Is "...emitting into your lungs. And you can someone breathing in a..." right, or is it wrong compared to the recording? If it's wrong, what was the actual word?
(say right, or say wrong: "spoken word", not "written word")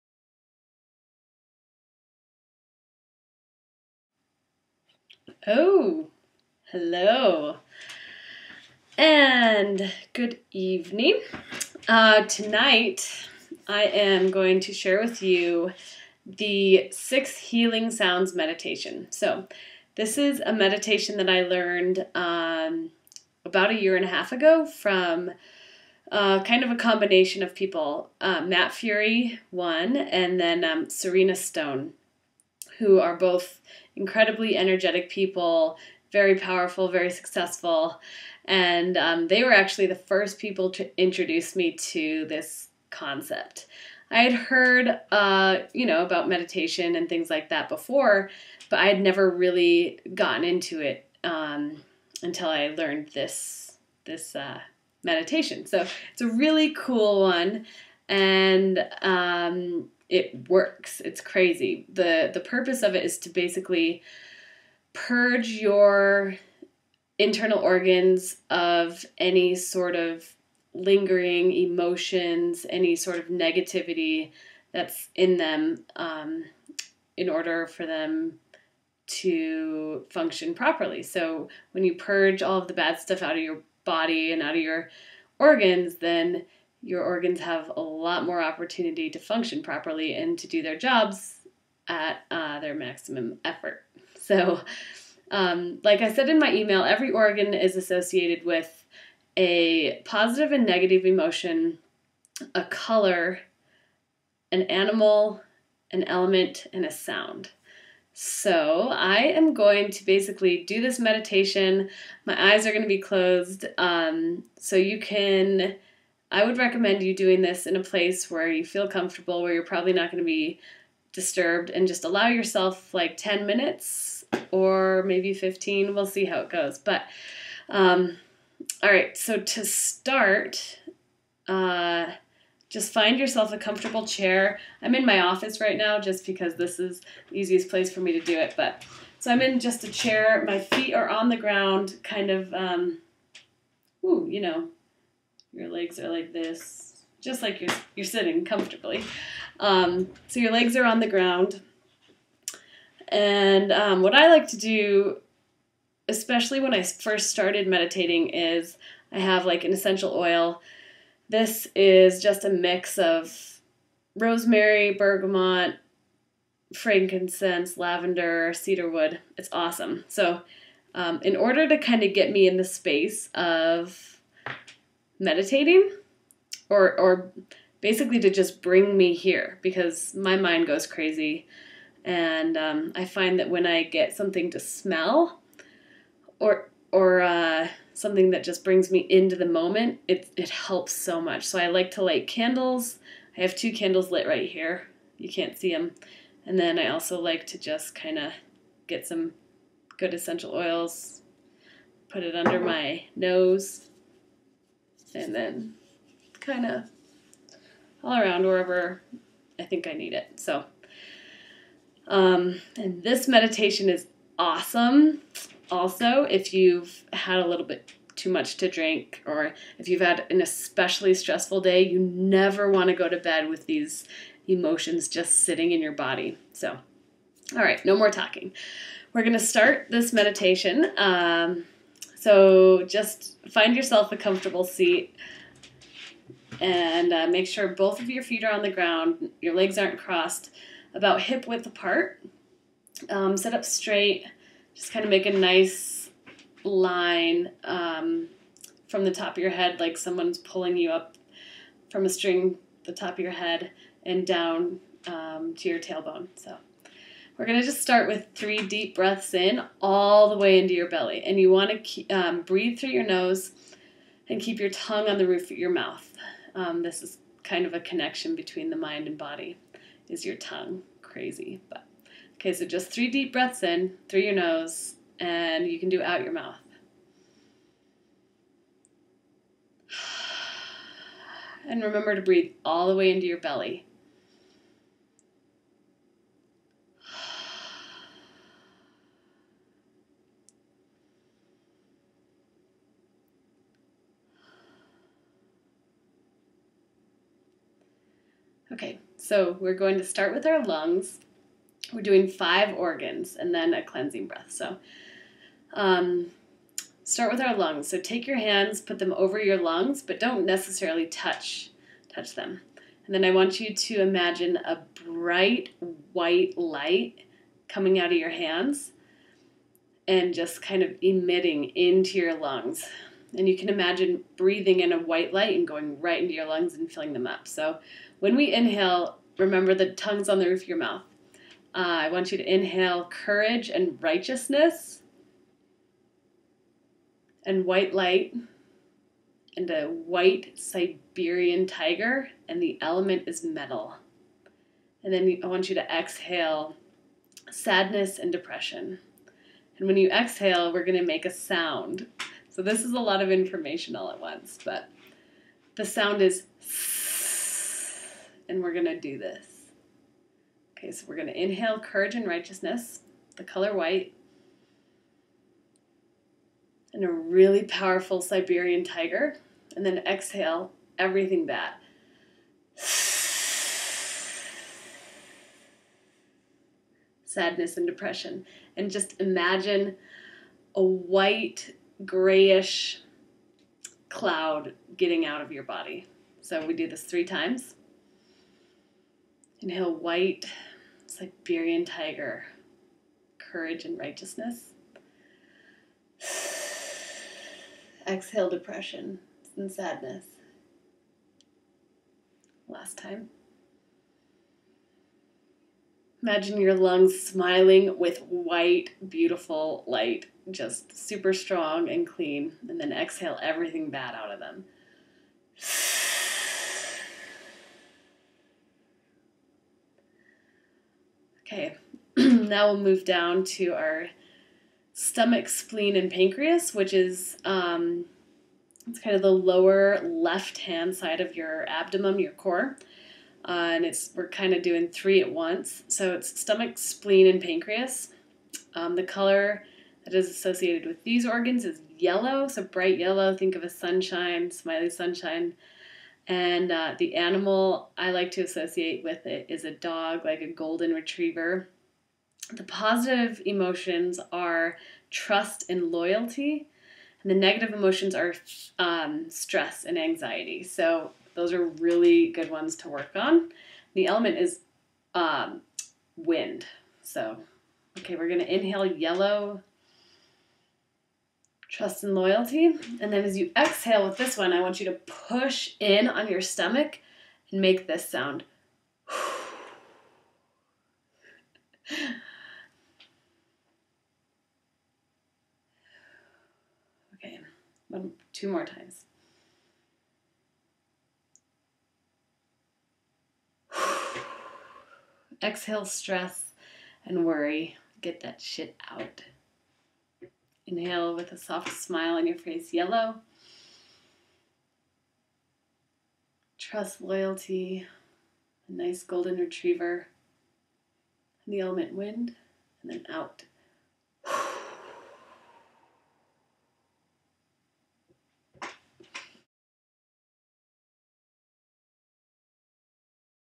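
wrong: "imagine", not "someone".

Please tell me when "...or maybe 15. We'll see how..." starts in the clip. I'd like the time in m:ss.
2:04.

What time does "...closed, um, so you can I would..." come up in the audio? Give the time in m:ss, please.
1:53.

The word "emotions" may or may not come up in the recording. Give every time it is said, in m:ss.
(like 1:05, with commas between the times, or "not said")
1:11, 1:41, 3:44, 7:33, 7:37.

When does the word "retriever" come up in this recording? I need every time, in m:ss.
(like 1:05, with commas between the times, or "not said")
7:30, 8:29.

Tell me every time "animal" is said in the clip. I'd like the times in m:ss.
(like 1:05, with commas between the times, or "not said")
1:44, 7:27.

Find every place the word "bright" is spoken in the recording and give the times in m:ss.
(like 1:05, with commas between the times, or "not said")
5:15, 7:22.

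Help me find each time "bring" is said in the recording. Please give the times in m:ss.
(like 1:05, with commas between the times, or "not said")
2:58, 3:08.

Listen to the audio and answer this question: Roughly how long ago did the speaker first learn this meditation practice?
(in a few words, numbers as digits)
a year and a half.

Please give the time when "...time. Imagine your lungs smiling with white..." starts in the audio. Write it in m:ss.
6:42.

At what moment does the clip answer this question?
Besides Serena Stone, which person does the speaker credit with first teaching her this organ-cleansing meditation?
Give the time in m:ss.
0:28.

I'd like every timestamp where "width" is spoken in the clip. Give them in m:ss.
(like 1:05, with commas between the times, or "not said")
4:01.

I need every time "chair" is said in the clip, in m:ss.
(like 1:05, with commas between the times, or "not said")
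2:14, 2:19.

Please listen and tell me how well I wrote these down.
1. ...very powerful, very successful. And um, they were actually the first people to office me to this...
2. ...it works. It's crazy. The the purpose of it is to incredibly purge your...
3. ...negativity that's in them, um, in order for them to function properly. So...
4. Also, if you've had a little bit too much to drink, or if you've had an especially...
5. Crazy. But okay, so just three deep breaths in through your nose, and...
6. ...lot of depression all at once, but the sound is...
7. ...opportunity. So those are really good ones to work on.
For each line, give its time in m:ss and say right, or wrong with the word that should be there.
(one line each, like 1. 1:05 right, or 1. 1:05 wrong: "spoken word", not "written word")
1. 0:36 wrong: "introduce", not "office"
2. 1:00 wrong: "basically", not "incredibly"
3. 1:13 right
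4. 3:35 right
5. 4:31 right
6. 5:52 wrong: "information", not "depression"
7. 7:39 wrong: "anxiety", not "opportunity".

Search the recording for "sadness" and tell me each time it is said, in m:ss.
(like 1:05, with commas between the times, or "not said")
5:47, 6:12, 6:39.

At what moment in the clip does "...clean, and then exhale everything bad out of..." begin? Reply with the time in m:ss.
6:52.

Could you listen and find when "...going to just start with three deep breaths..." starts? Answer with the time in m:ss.
4:17.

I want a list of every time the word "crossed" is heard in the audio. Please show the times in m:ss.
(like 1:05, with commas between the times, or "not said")
3:59.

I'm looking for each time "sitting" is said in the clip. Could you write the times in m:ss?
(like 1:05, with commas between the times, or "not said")
2:28, 3:45.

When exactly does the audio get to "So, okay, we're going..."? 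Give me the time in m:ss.
7:47.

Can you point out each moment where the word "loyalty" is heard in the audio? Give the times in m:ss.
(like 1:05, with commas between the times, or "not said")
7:35, 7:52, 8:27.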